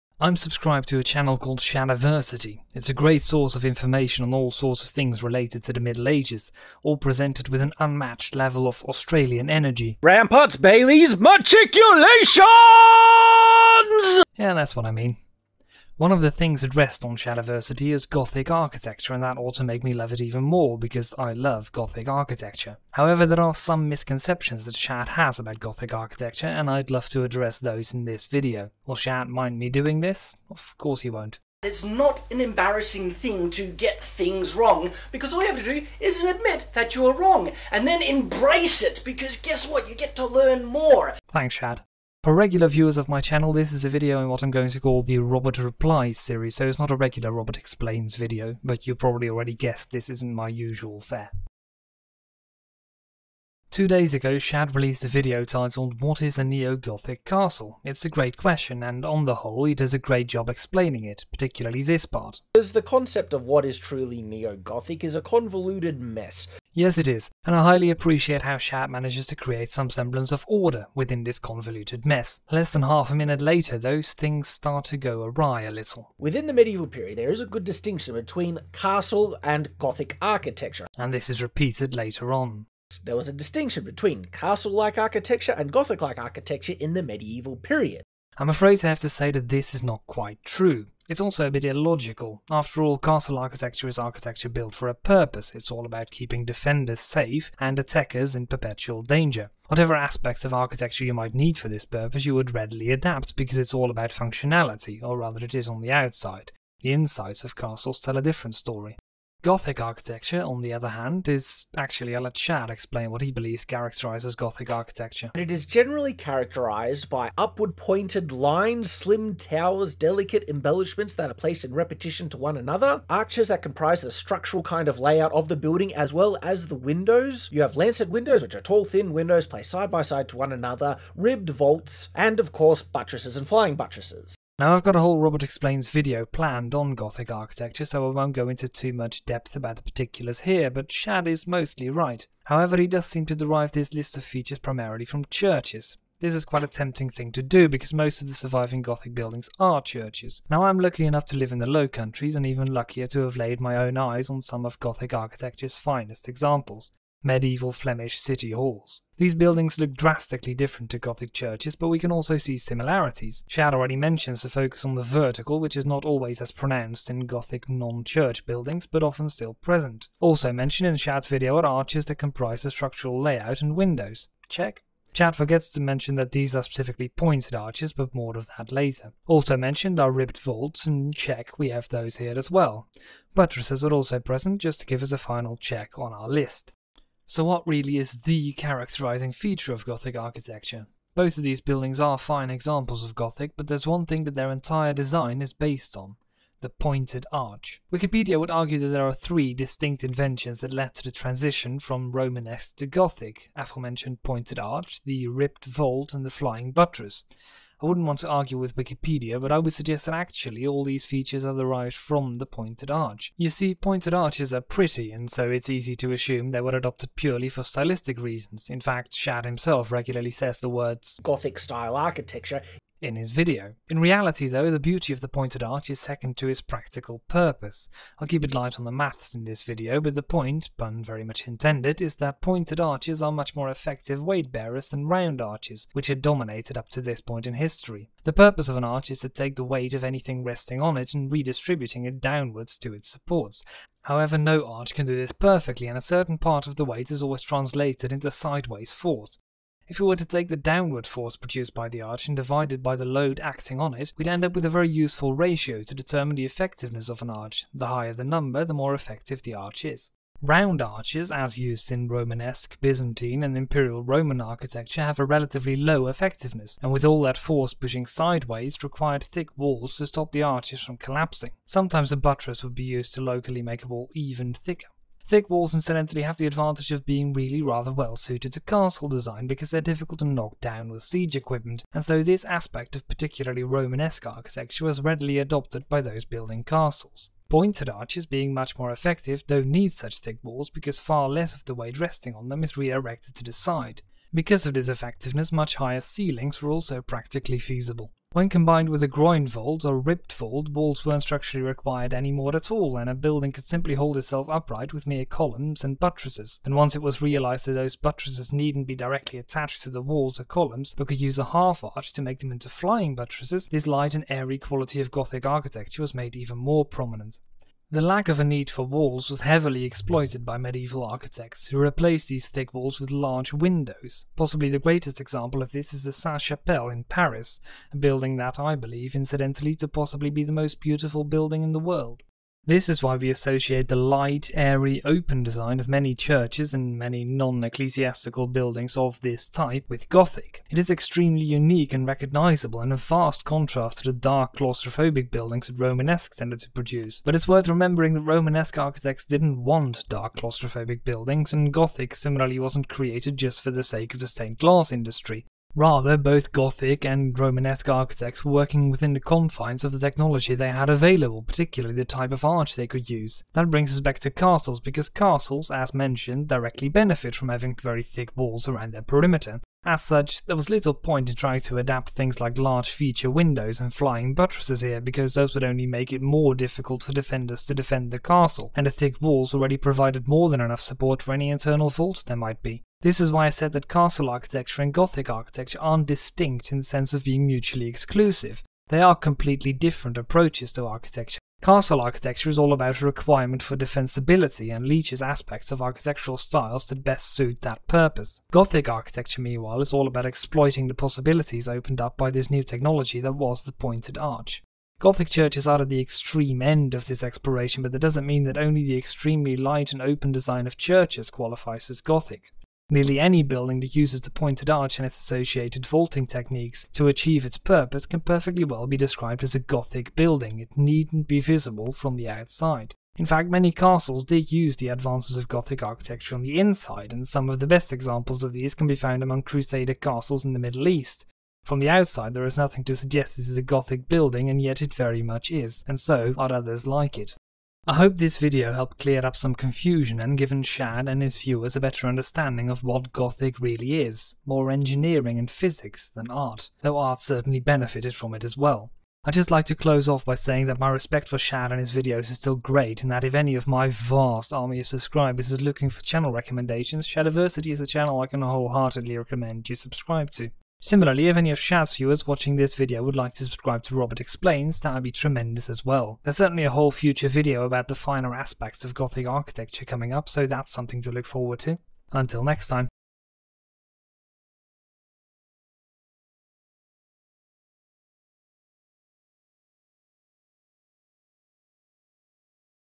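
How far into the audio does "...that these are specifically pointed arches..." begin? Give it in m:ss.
2:56.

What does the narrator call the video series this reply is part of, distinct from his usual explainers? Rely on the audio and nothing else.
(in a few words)
Robert Replies.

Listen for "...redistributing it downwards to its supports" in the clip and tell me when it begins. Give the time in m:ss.
4:01.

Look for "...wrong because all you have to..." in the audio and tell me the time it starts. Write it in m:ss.
0:34.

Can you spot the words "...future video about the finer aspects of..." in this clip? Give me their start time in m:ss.
7:46.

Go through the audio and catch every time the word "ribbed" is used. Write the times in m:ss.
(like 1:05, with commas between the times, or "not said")
2:11, 3:00, 3:25, 4:59.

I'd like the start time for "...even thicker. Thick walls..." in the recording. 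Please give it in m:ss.
4:34.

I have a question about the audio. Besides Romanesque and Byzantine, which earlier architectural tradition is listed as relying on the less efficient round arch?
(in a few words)
Imperial Roman.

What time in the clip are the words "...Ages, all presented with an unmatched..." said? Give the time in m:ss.
0:06.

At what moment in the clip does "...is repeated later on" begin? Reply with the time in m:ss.
1:21.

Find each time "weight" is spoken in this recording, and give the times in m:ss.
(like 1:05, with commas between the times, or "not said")
3:54, 3:59, 4:06, 4:51.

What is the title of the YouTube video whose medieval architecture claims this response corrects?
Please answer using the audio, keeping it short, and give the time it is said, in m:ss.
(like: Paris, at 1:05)
What is a Neo-Gothic Castle?, at 0:55.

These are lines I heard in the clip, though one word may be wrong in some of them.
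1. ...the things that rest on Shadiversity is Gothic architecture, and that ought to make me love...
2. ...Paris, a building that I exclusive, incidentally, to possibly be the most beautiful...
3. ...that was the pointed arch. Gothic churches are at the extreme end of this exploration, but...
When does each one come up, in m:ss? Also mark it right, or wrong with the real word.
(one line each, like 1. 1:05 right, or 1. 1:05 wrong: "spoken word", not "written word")
1. 0:16 right
2. 5:27 wrong: "believe", not "exclusive"
3. 6:43 right.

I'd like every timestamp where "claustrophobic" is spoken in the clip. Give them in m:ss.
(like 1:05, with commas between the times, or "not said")
5:44, 5:50.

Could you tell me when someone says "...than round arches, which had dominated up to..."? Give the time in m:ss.
3:54.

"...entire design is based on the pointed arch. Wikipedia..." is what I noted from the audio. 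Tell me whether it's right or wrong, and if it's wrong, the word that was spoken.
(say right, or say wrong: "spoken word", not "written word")
right.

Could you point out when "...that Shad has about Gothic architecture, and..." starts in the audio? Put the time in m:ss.
0:24.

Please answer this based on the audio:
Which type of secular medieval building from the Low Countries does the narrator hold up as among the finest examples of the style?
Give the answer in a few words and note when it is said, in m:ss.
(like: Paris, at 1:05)
Flemish city halls, at 2:37.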